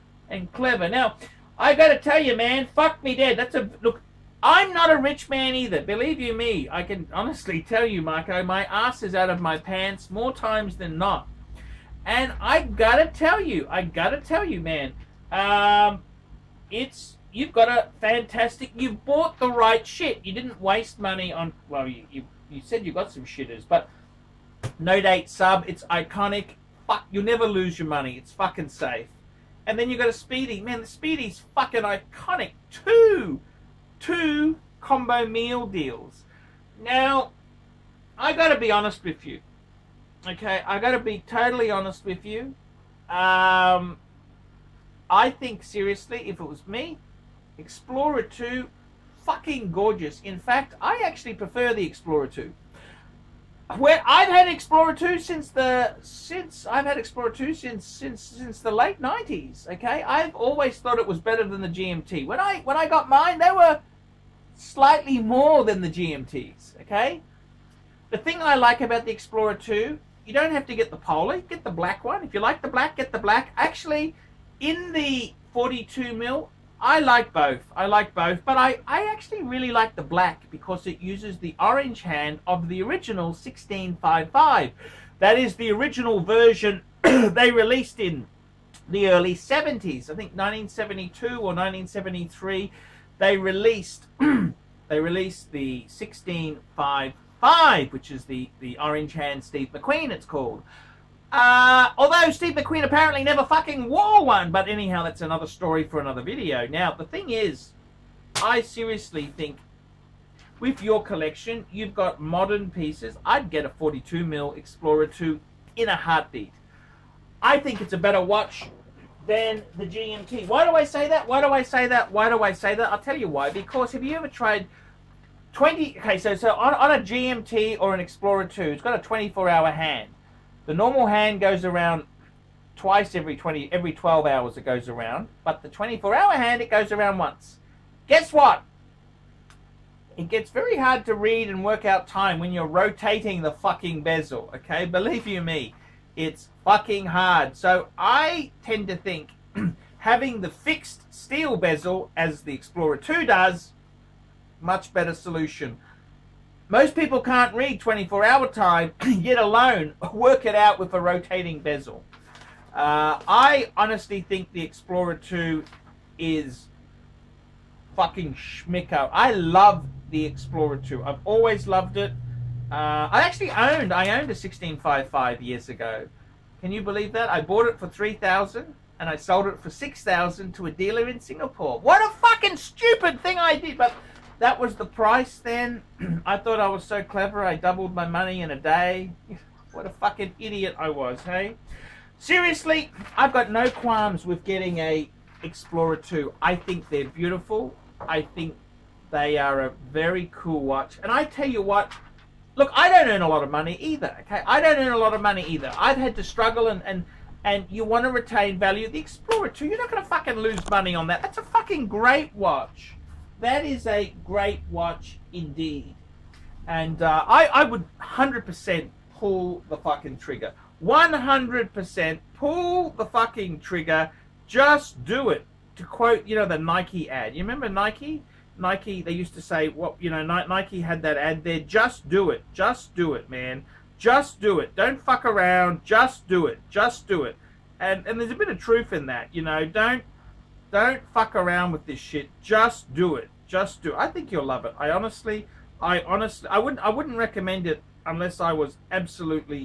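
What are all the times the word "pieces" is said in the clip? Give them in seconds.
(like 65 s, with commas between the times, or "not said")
112 s.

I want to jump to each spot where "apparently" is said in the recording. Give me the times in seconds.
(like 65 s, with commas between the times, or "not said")
102 s.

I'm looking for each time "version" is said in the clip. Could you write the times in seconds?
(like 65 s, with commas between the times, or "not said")
86 s.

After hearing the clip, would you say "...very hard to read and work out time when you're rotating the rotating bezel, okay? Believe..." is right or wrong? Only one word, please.
wrong.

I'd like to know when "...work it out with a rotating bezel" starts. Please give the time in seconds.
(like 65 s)
160 s.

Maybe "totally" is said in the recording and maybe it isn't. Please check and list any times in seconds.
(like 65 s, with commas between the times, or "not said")
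41 s.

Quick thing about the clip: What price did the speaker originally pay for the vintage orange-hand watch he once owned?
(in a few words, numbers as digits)
3000.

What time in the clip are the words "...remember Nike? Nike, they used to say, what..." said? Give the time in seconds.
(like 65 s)
227 s.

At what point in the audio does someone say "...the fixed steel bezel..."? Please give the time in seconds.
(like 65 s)
150 s.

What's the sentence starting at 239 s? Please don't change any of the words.
Don't don't fuck around with this shit.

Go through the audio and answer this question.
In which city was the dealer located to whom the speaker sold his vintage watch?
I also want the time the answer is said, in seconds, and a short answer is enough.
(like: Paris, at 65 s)
Singapore, at 181 s.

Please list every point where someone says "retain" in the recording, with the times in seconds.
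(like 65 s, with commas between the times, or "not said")
208 s.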